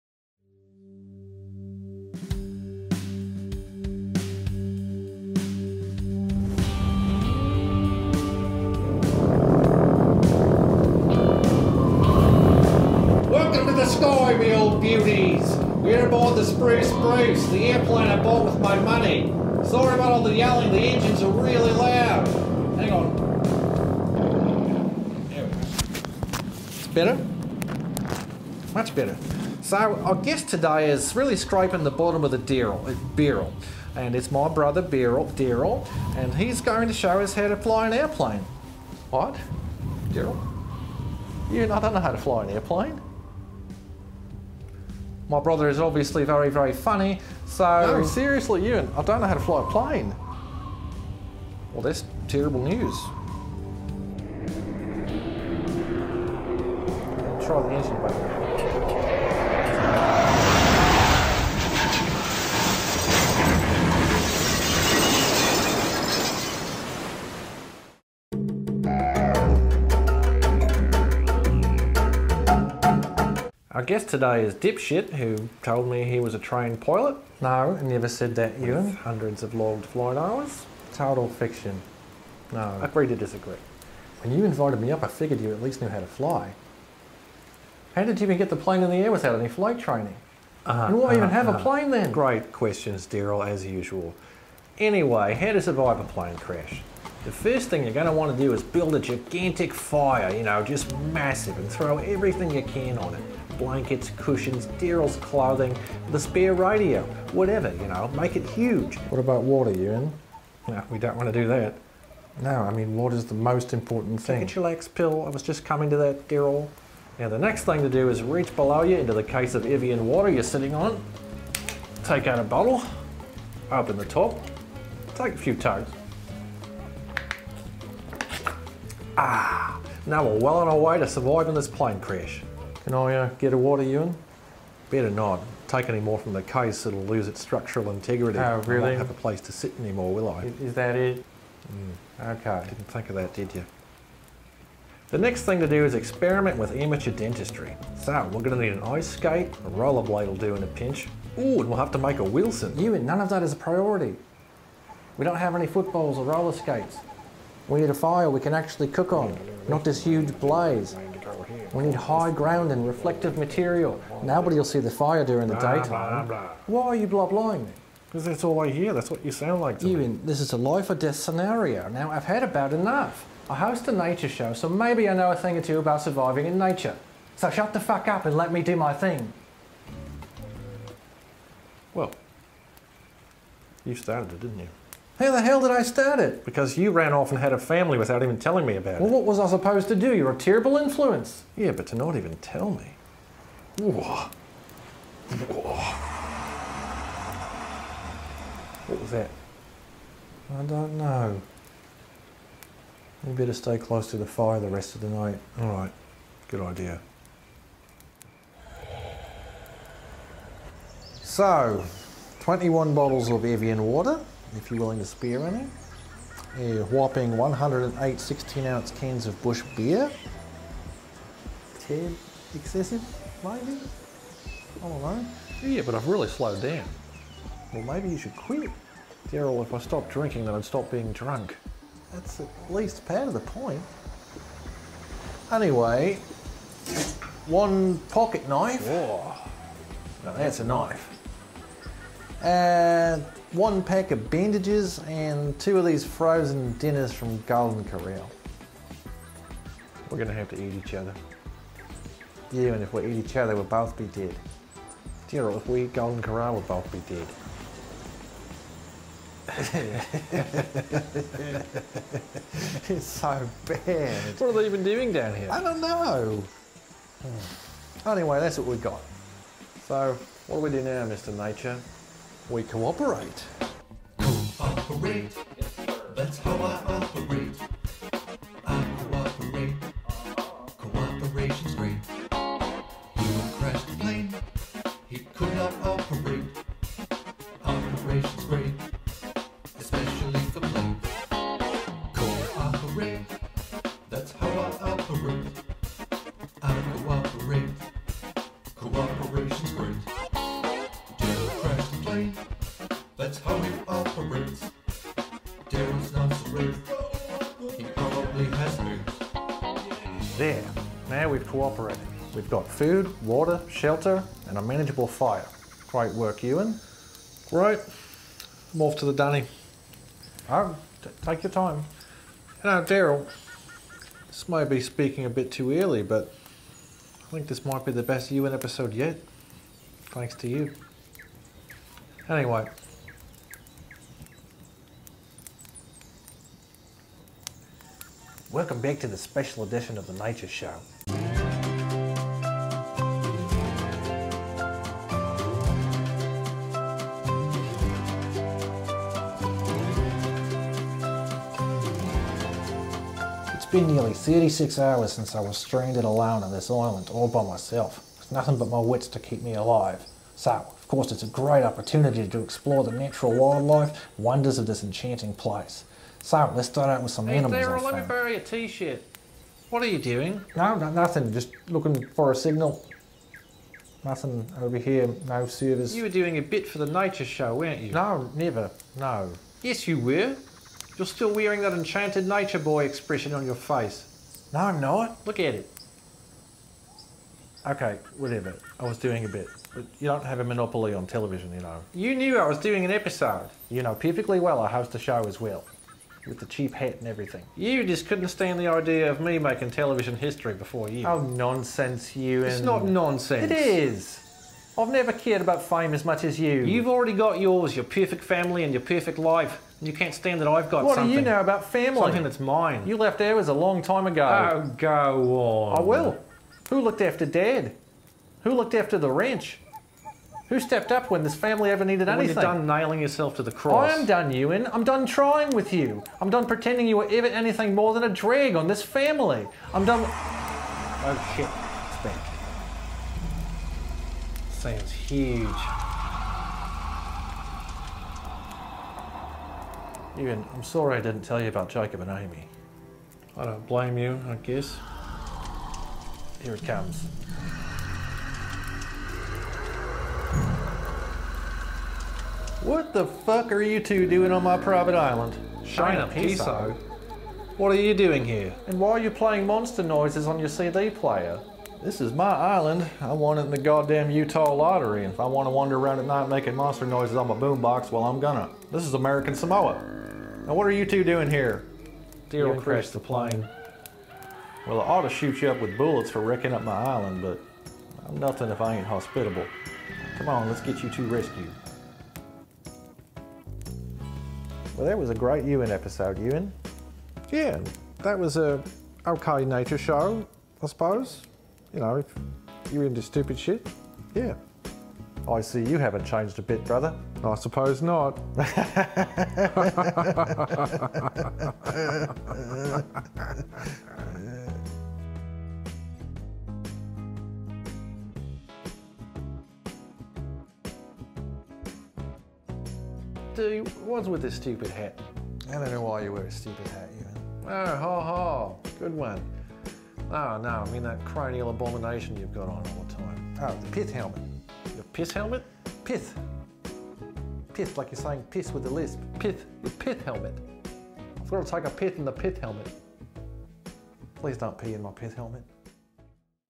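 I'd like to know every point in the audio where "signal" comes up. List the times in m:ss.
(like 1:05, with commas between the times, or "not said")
6:12.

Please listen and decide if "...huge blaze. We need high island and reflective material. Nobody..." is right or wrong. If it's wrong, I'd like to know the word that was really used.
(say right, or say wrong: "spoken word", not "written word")
wrong: "ground", not "island".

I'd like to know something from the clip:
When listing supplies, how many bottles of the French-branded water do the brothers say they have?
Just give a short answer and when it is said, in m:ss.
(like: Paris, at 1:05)
21, at 3:32.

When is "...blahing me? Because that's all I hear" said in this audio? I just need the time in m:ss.
2:47.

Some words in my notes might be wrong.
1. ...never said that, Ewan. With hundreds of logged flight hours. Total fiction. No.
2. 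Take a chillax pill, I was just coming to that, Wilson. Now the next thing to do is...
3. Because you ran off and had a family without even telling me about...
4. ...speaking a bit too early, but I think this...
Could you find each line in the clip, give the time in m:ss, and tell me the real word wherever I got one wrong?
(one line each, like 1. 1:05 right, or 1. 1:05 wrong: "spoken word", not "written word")
1. 1:17 right
2. 1:54 wrong: "Darryl", not "Wilson"
3. 3:06 right
4. 5:24 right.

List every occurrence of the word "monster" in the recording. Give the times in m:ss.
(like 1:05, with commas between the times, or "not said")
7:39, 7:46.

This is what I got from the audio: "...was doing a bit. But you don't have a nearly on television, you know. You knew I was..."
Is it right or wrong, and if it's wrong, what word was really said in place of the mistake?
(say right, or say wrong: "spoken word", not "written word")
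wrong: "monopoly", not "nearly".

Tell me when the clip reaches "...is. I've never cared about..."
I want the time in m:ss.
6:43.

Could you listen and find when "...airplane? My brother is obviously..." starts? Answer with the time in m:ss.
0:42.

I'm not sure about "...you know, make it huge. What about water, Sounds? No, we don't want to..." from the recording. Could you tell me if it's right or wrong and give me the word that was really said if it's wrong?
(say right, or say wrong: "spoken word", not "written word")
wrong: "Ewan", not "Sounds".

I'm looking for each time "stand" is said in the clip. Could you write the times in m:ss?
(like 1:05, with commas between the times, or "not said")
6:38, 6:50.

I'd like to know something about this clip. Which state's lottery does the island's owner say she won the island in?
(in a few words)
Utah.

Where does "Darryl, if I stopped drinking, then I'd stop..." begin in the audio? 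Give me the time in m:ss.
3:49.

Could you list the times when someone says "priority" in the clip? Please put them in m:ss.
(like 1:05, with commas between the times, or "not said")
2:33.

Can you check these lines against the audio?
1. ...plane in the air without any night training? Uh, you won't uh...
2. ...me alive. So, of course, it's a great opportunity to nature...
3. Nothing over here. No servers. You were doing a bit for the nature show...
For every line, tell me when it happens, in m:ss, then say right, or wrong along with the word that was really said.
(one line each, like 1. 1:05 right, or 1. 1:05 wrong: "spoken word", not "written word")
1. 1:28 wrong: "flight", not "night"
2. 5:59 wrong: "explore", not "nature"
3. 6:14 right.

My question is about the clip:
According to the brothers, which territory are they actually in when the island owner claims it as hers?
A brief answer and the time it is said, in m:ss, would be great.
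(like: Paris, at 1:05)
American Samoa, at 7:48.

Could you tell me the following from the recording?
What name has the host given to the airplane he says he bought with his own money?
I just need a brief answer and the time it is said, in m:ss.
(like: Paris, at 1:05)
Spruce Bruce, at 0:16.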